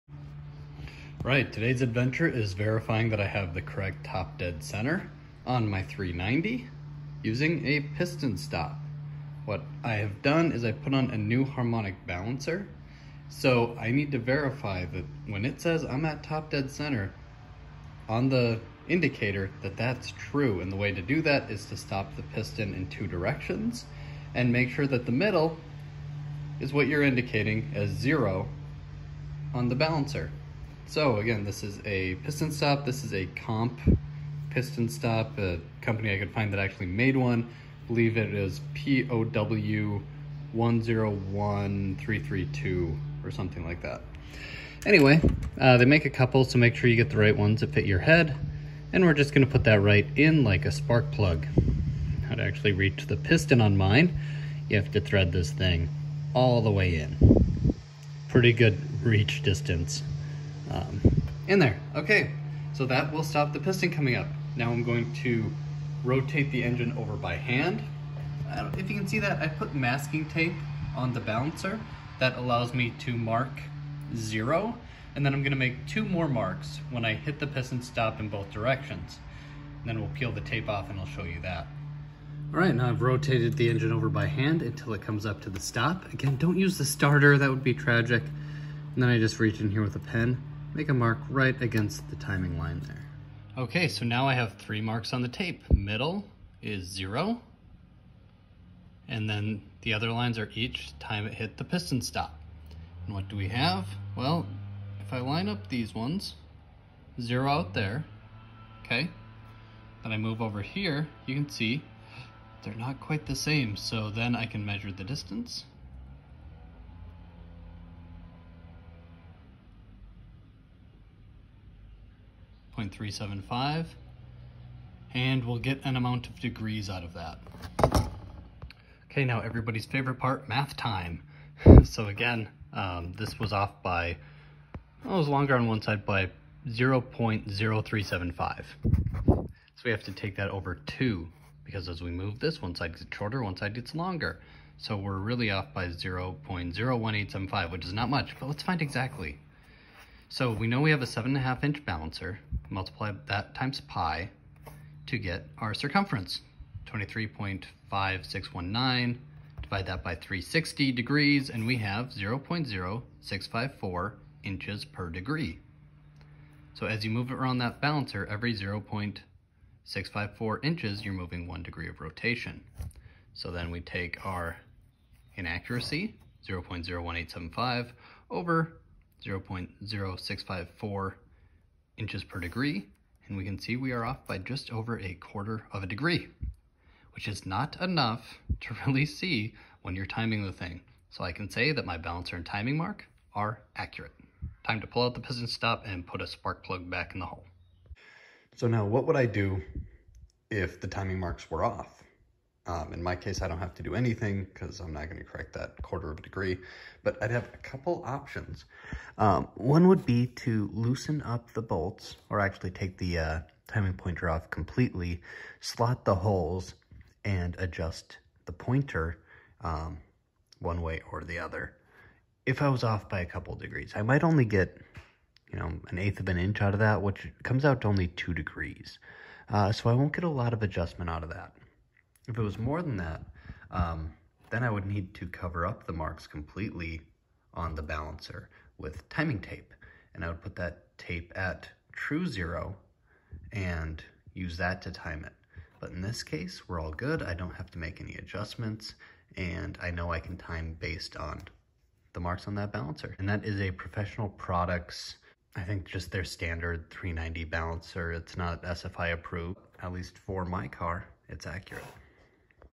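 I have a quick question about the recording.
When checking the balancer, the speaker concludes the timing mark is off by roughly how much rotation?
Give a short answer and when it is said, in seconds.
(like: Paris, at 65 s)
a quarter of a degree, at 185 s.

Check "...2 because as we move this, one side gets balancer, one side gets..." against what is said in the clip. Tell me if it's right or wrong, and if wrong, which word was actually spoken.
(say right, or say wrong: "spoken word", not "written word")
wrong: "shorter", not "balancer".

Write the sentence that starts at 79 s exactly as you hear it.
And then we'll peel the tape off and I'll show you that.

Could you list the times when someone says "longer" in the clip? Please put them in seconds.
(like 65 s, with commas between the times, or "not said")
135 s, 143 s.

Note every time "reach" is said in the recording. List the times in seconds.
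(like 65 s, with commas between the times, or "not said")
52 s, 59 s, 89 s.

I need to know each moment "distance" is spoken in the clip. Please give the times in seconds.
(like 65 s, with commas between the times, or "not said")
59 s, 115 s.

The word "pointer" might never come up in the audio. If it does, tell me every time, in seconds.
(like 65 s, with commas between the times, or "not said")
213 s, 218 s.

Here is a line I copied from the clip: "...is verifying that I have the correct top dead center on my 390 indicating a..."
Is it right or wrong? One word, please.
wrong.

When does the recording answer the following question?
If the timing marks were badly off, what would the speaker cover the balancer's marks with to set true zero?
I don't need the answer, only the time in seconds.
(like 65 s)
239 s.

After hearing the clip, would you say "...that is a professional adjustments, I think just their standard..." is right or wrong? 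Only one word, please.
wrong.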